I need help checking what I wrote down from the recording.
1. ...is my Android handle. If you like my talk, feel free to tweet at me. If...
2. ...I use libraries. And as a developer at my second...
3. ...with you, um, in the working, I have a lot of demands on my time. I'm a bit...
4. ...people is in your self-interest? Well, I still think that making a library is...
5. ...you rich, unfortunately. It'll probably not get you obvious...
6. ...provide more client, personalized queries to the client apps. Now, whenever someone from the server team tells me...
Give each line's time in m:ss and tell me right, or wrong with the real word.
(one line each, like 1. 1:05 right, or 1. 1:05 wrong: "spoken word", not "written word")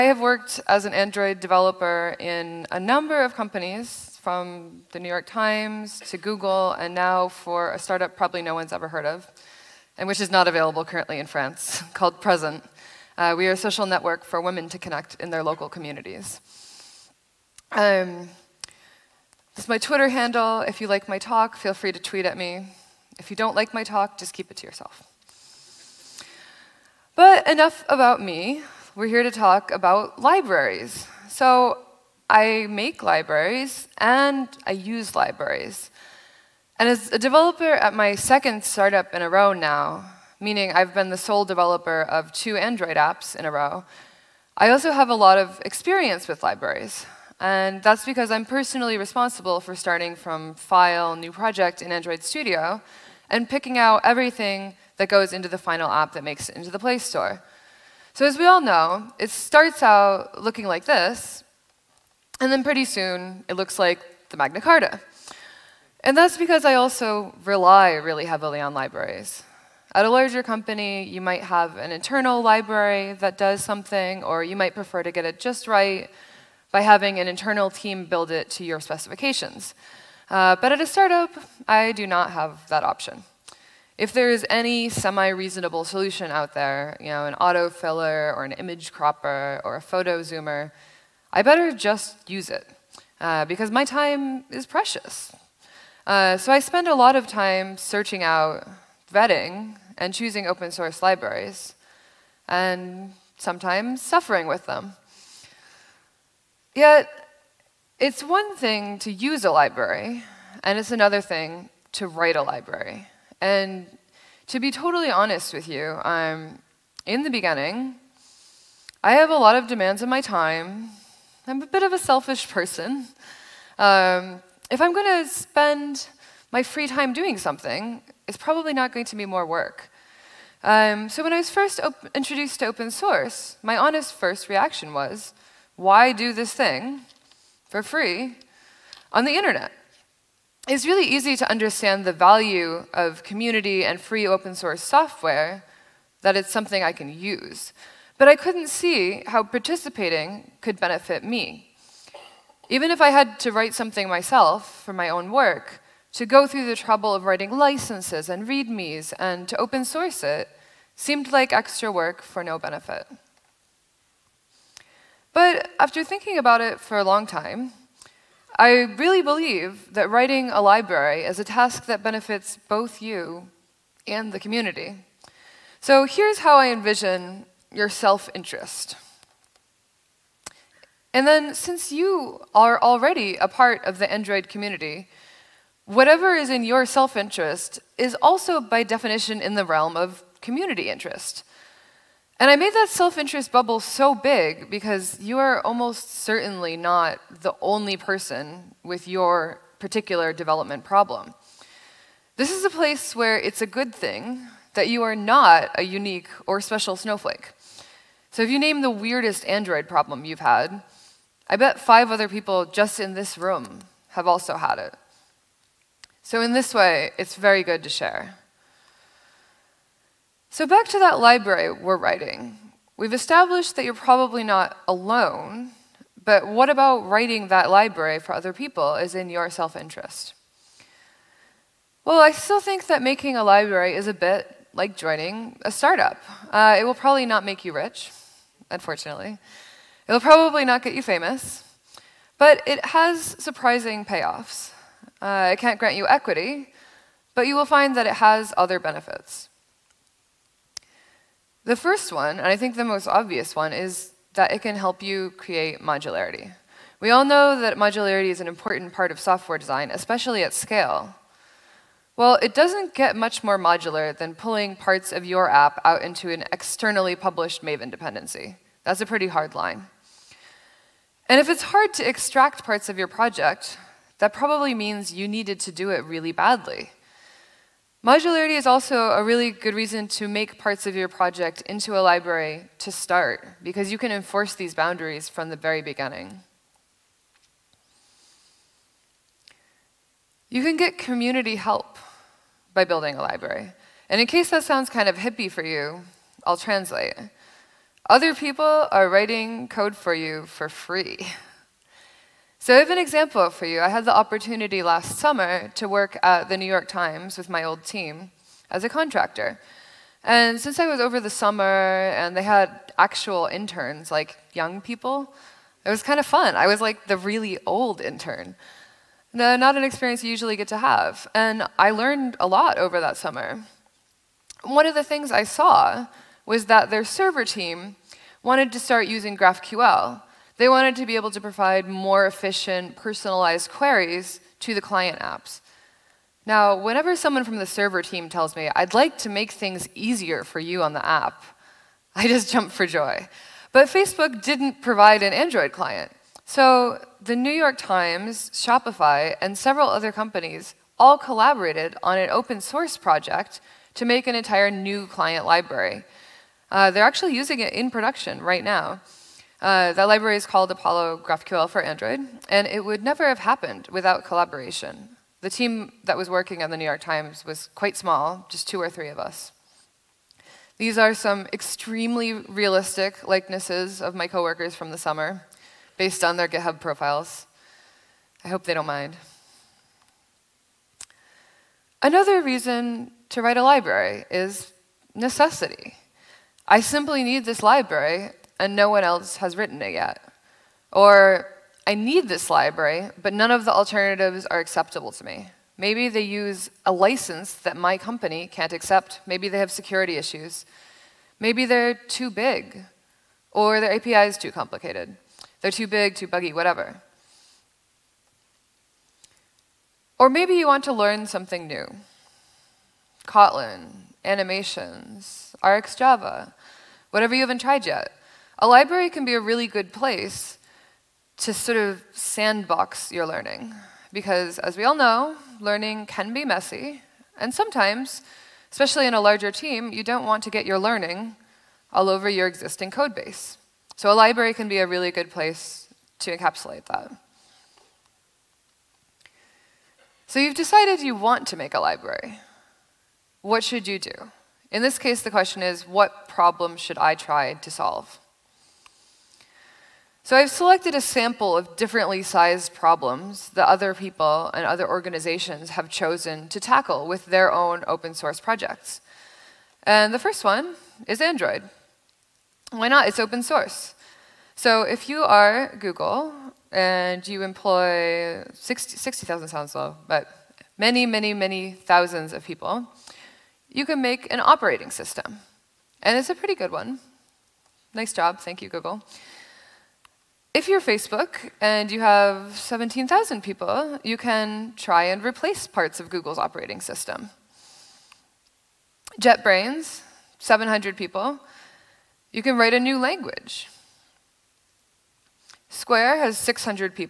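1. 0:19 wrong: "Twitter", not "Android"
2. 0:34 right
3. 1:55 wrong: "beginning", not "working"
4. 3:48 right
5. 3:57 wrong: "famous", not "obvious"
6. 5:31 wrong: "efficient", not "client".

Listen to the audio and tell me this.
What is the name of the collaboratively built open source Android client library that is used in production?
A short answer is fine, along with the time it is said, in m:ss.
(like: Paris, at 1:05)
Apollo GraphQL for Android, at 6:00.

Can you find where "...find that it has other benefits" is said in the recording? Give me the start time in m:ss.
4:07.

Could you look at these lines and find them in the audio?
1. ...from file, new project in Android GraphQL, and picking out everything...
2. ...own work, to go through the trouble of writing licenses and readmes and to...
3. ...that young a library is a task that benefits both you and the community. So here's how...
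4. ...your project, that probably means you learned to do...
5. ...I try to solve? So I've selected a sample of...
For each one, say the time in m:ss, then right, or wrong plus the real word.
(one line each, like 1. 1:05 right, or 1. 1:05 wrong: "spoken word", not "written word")
1. 0:50 wrong: "Studio", not "GraphQL"
2. 2:35 right
3. 2:49 wrong: "writing", not "young"
4. 4:32 wrong: "needed", not "learned"
5. 7:26 right.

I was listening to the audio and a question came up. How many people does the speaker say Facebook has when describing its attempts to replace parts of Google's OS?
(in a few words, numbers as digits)
17,000.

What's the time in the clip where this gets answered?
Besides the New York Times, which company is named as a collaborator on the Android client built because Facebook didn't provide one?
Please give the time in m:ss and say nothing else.
5:48.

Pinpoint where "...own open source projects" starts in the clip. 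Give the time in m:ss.
7:37.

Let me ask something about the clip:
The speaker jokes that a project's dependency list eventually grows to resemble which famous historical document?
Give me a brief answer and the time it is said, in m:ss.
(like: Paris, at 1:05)
Magna Carta, at 1:04.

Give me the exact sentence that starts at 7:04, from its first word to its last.
Because as we all know, learning can be messy.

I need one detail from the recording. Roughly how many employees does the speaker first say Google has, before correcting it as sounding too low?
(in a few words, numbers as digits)
60,000.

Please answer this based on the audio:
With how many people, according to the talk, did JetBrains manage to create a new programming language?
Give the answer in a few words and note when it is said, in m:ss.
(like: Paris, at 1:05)
700, at 8:10.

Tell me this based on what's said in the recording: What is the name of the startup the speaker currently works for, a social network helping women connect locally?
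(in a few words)
Present.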